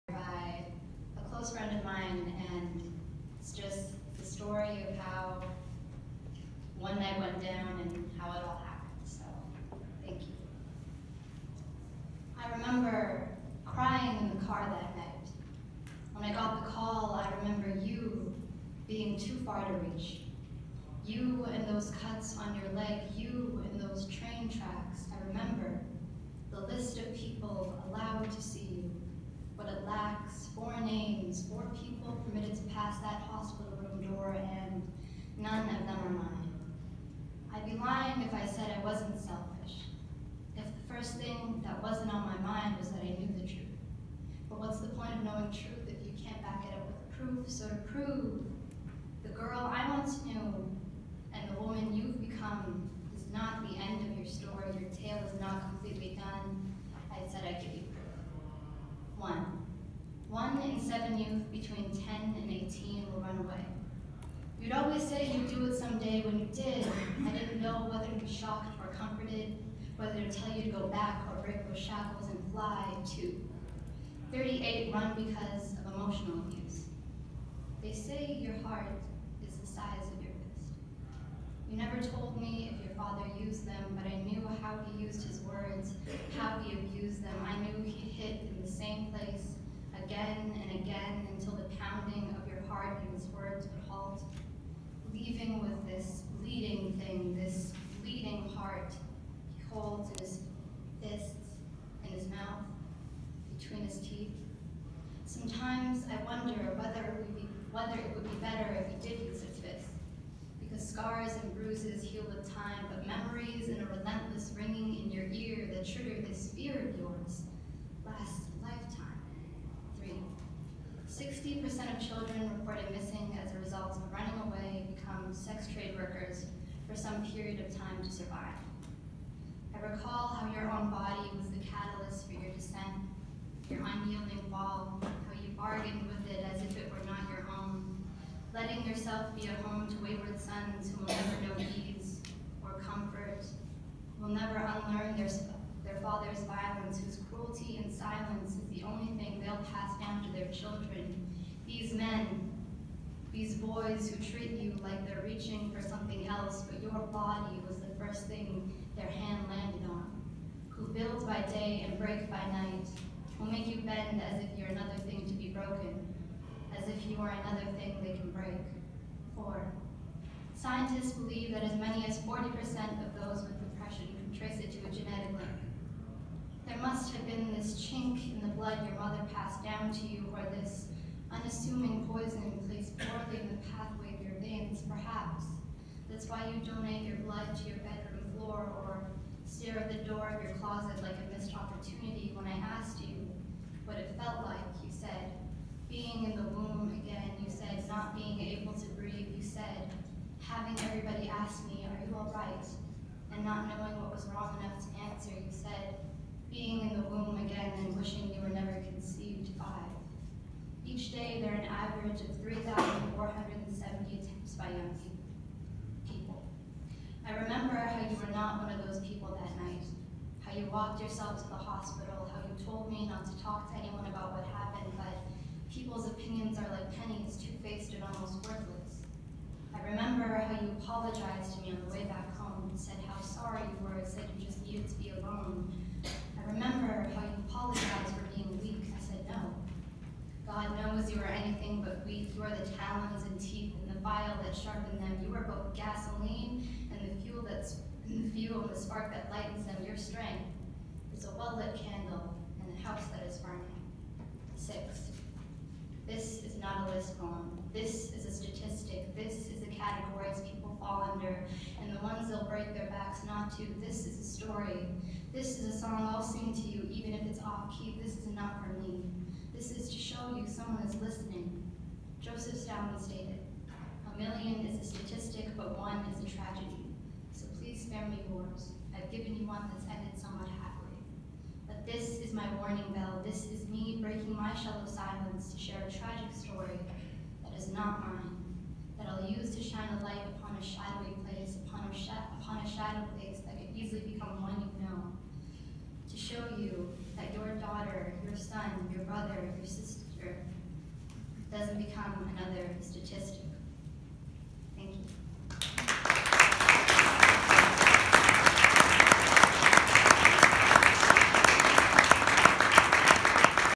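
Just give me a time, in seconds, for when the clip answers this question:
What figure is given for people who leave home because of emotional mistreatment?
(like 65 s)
74 s.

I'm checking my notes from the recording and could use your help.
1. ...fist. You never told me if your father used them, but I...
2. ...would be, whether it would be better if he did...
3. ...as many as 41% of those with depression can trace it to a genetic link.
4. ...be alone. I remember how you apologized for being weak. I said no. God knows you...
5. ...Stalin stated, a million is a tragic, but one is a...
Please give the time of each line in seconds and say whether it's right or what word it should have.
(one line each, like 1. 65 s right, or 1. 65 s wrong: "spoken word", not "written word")
1. 80 s right
2. 107 s right
3. 171 s wrong: "40", not "41"
4. 234 s right
5. 272 s wrong: "statistic", not "tragic".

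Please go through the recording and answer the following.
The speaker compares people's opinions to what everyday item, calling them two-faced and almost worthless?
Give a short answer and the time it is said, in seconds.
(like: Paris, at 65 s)
pennies, at 227 s.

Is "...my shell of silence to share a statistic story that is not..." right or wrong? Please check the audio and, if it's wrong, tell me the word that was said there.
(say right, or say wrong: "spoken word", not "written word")
wrong: "tragic", not "statistic".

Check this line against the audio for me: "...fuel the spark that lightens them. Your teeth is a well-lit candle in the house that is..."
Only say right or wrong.
wrong.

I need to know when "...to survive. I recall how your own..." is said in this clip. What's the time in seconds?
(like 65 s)
128 s.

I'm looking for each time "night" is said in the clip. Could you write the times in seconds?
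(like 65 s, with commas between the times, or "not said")
6 s, 14 s, 162 s, 219 s.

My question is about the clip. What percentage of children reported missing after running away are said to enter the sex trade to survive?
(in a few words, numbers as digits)
60%.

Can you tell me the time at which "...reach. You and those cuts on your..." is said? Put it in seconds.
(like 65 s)
19 s.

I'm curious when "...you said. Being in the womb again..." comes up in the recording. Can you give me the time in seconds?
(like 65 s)
194 s.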